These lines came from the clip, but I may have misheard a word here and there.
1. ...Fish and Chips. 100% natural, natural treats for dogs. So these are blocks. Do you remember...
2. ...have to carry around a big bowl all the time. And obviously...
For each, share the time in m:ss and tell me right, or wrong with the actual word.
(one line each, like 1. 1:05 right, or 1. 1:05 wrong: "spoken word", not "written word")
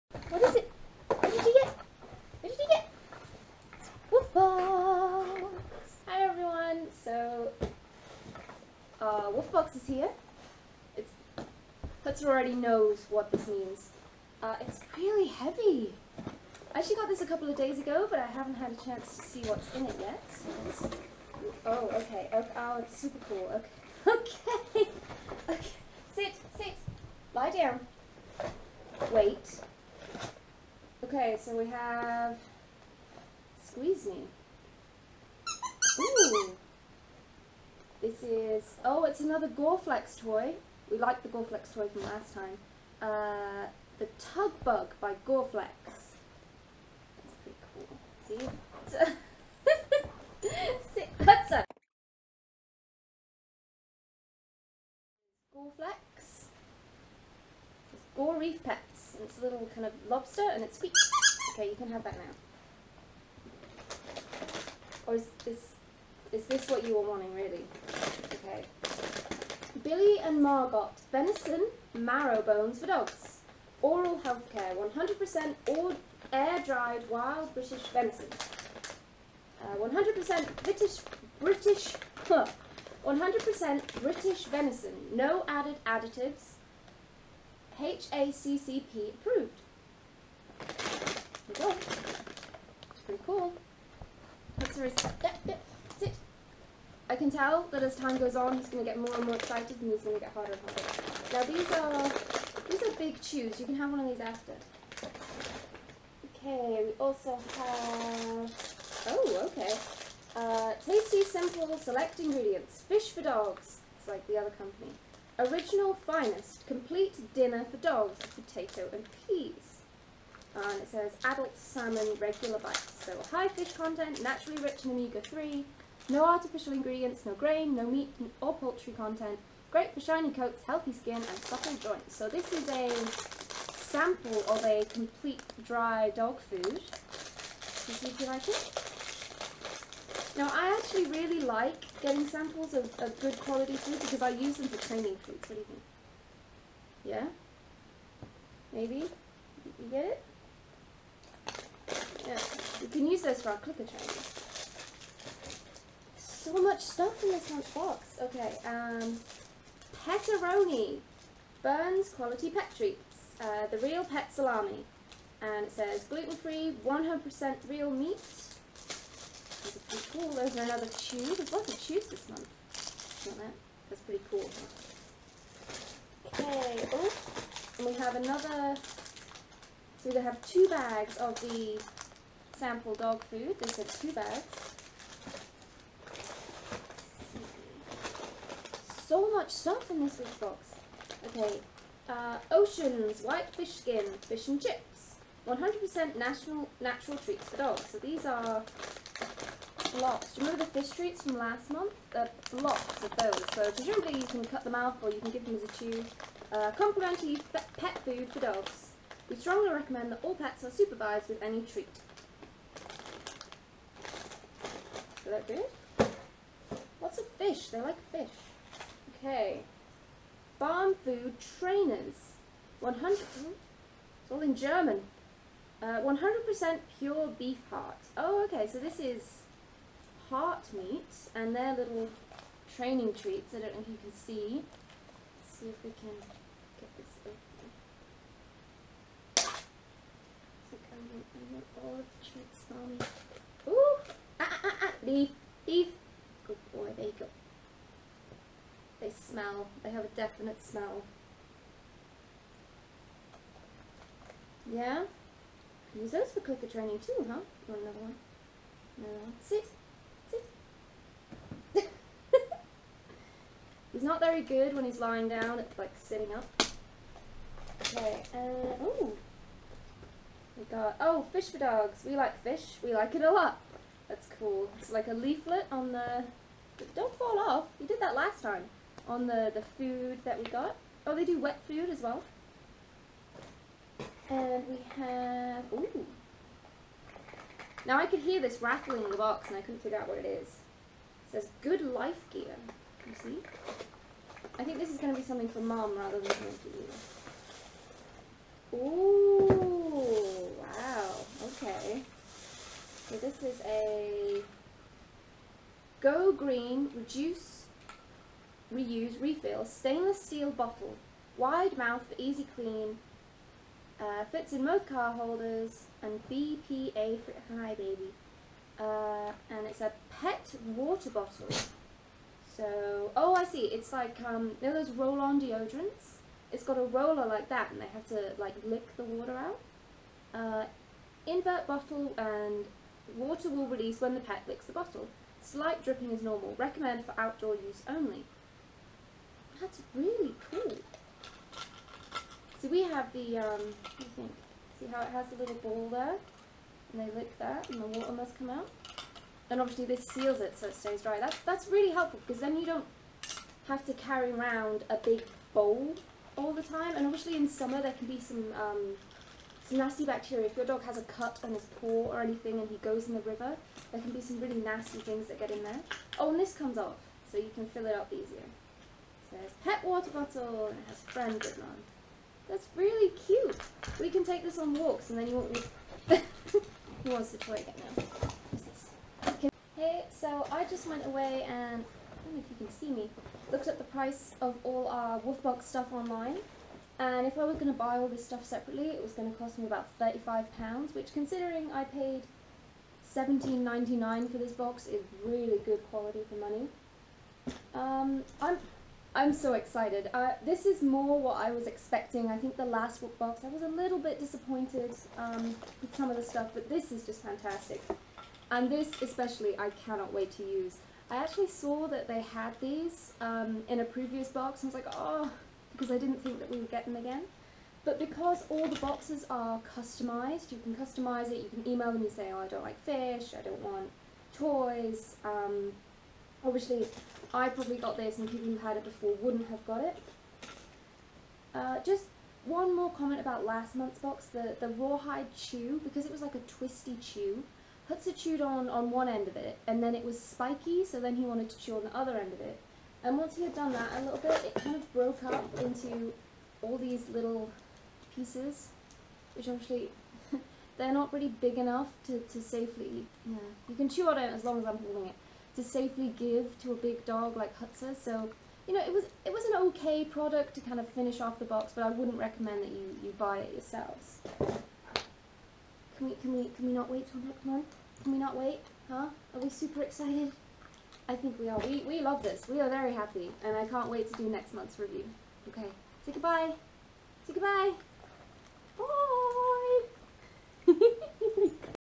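1. 3:14 right
2. 5:53 right.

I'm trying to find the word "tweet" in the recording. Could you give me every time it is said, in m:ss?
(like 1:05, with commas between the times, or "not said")
not said.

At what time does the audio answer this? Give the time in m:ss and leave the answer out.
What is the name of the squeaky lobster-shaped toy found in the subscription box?
0:44.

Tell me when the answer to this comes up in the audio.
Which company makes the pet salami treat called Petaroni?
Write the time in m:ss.
2:41.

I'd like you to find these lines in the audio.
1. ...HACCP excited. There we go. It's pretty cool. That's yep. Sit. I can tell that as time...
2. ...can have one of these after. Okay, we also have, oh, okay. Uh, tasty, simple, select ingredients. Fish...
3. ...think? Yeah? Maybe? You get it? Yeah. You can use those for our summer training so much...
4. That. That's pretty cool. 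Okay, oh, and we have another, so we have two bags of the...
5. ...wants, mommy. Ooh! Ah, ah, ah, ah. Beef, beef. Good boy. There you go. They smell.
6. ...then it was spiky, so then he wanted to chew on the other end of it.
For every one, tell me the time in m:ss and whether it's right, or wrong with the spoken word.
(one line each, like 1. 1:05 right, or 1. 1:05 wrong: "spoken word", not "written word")
1. 1:27 wrong: "approved", not "excited"
2. 1:43 right
3. 2:25 wrong: "clicker", not "summer"
4. 2:53 right
5. 4:02 wrong: "treats", not "wants"
6. 7:19 right.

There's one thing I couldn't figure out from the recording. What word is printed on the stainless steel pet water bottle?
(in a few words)
friend.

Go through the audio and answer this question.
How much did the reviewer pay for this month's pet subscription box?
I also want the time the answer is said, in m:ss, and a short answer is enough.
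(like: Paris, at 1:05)
$17.99, at 6:33.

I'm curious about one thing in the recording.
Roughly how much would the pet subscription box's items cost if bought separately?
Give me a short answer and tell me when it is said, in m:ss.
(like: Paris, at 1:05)
£35, at 6:29.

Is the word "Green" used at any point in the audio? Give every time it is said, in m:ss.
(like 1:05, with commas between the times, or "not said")
5:06.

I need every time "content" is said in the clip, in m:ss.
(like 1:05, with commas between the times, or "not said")
2:03, 2:08.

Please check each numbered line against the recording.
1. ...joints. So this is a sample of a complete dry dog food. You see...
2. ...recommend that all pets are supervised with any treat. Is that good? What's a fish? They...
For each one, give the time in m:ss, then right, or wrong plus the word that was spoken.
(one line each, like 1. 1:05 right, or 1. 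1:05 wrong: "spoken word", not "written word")
1. 2:11 right
2. 3:29 right.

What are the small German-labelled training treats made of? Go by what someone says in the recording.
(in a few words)
pure beef heart.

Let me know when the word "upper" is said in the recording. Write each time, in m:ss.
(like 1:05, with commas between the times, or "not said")
not said.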